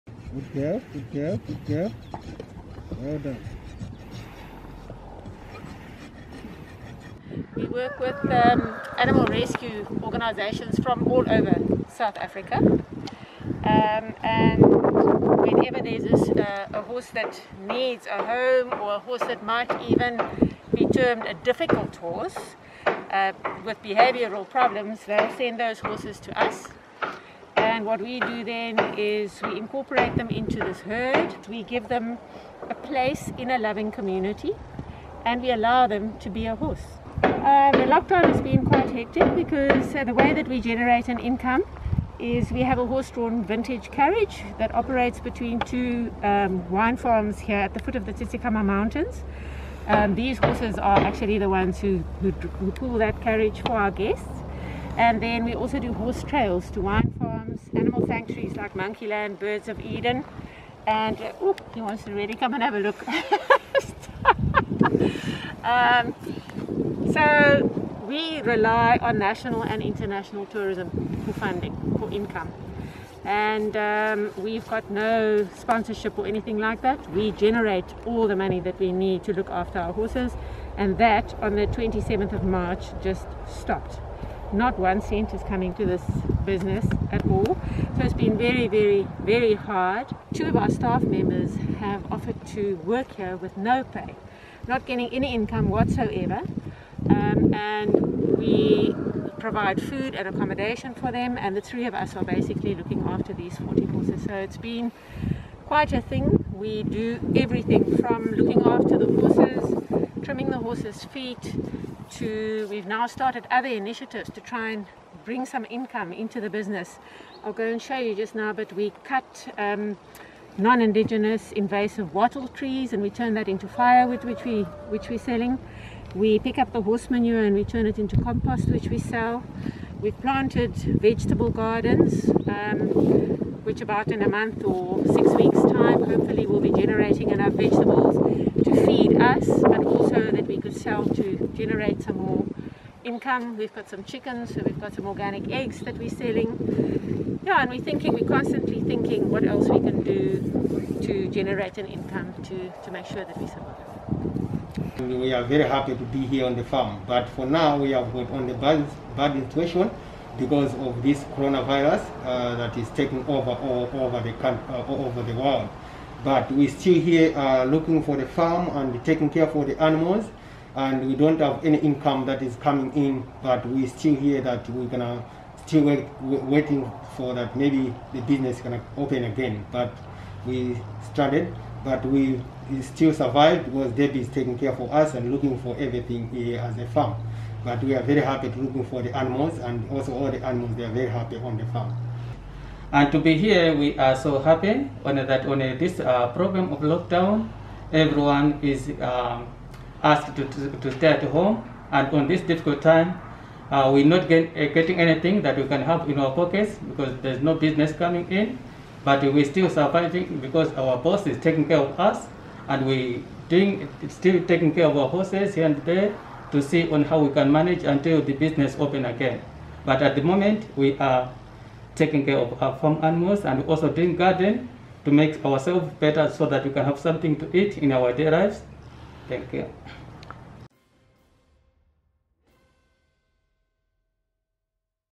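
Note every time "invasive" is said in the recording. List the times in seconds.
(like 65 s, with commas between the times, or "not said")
121 s.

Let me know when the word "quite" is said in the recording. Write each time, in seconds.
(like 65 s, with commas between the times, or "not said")
38 s, 105 s.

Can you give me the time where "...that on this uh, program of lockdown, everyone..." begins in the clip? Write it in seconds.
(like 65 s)
195 s.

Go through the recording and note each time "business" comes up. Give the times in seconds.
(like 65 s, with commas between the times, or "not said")
86 s, 116 s, 178 s, 207 s, 218 s.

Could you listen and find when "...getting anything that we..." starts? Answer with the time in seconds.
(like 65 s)
204 s.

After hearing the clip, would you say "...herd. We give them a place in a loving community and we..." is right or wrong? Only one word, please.
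right.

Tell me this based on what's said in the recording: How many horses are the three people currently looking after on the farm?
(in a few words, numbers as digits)
40.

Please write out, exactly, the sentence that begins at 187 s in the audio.
But we are very happy to looking for the animals and also all the animals, they are very happy on the farm.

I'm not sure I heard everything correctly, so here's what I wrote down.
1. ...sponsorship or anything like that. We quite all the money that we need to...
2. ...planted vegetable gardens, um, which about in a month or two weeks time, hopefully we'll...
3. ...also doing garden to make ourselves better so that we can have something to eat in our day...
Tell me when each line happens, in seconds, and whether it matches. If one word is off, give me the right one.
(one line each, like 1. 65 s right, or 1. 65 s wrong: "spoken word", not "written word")
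1. 75 s wrong: "generate", not "quite"
2. 130 s wrong: "six", not "two"
3. 223 s right.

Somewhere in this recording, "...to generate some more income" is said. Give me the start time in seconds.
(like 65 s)
141 s.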